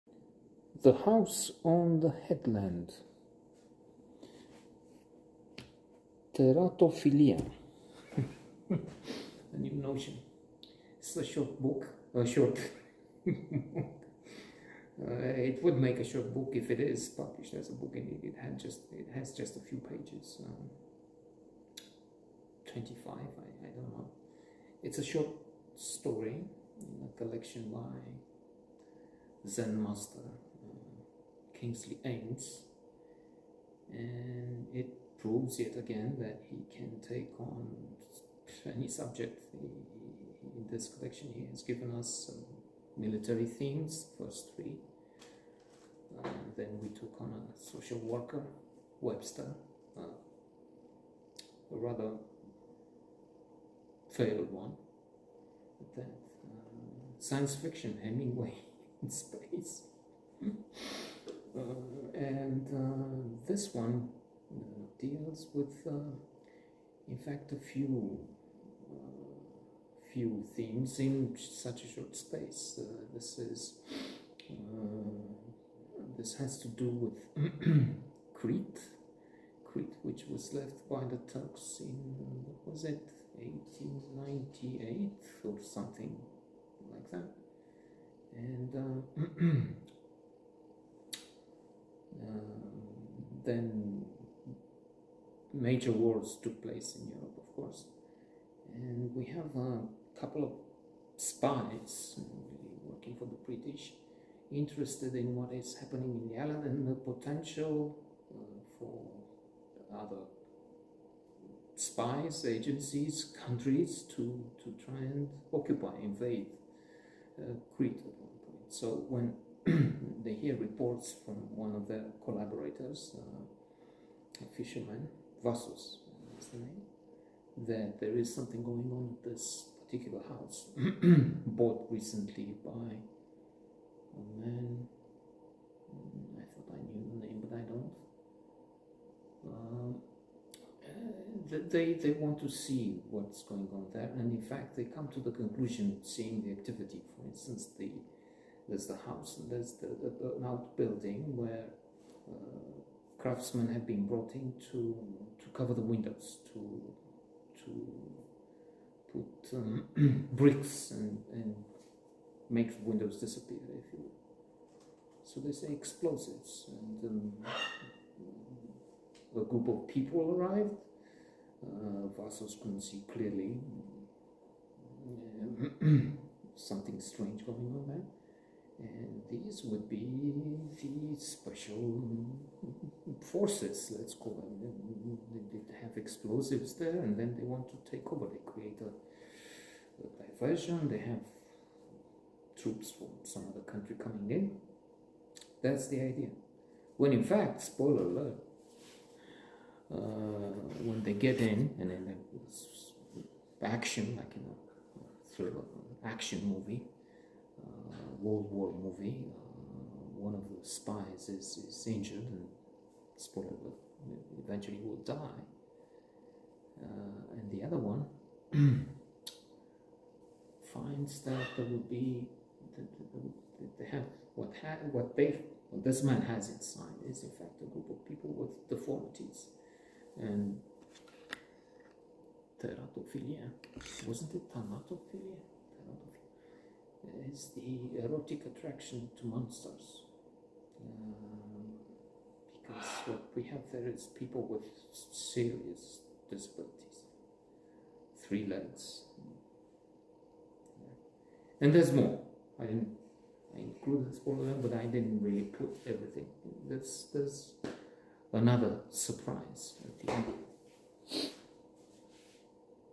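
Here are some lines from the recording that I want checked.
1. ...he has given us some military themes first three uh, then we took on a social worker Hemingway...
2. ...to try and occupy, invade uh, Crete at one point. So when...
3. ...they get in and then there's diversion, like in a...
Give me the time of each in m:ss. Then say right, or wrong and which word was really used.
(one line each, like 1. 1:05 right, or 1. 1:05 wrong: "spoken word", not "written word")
1. 0:41 wrong: "Webster", not "Hemingway"
2. 1:54 right
3. 3:21 wrong: "action", not "diversion".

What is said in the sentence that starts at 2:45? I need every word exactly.
So they say explosives, and um, a group of people arrived.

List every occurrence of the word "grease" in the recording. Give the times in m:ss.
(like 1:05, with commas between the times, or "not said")
not said.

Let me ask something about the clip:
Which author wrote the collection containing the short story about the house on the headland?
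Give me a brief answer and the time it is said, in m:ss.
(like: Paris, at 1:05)
Kingsley Amis, at 0:31.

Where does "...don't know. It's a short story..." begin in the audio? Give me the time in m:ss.
0:23.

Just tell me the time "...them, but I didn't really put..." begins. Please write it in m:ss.
4:14.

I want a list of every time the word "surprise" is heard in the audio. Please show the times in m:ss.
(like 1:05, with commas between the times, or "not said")
4:18.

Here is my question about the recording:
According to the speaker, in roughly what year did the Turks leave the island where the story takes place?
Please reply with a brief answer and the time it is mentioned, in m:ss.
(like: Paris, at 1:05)
1898, at 1:23.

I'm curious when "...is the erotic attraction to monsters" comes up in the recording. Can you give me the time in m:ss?
3:57.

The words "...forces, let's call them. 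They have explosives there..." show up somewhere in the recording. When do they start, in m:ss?
3:03.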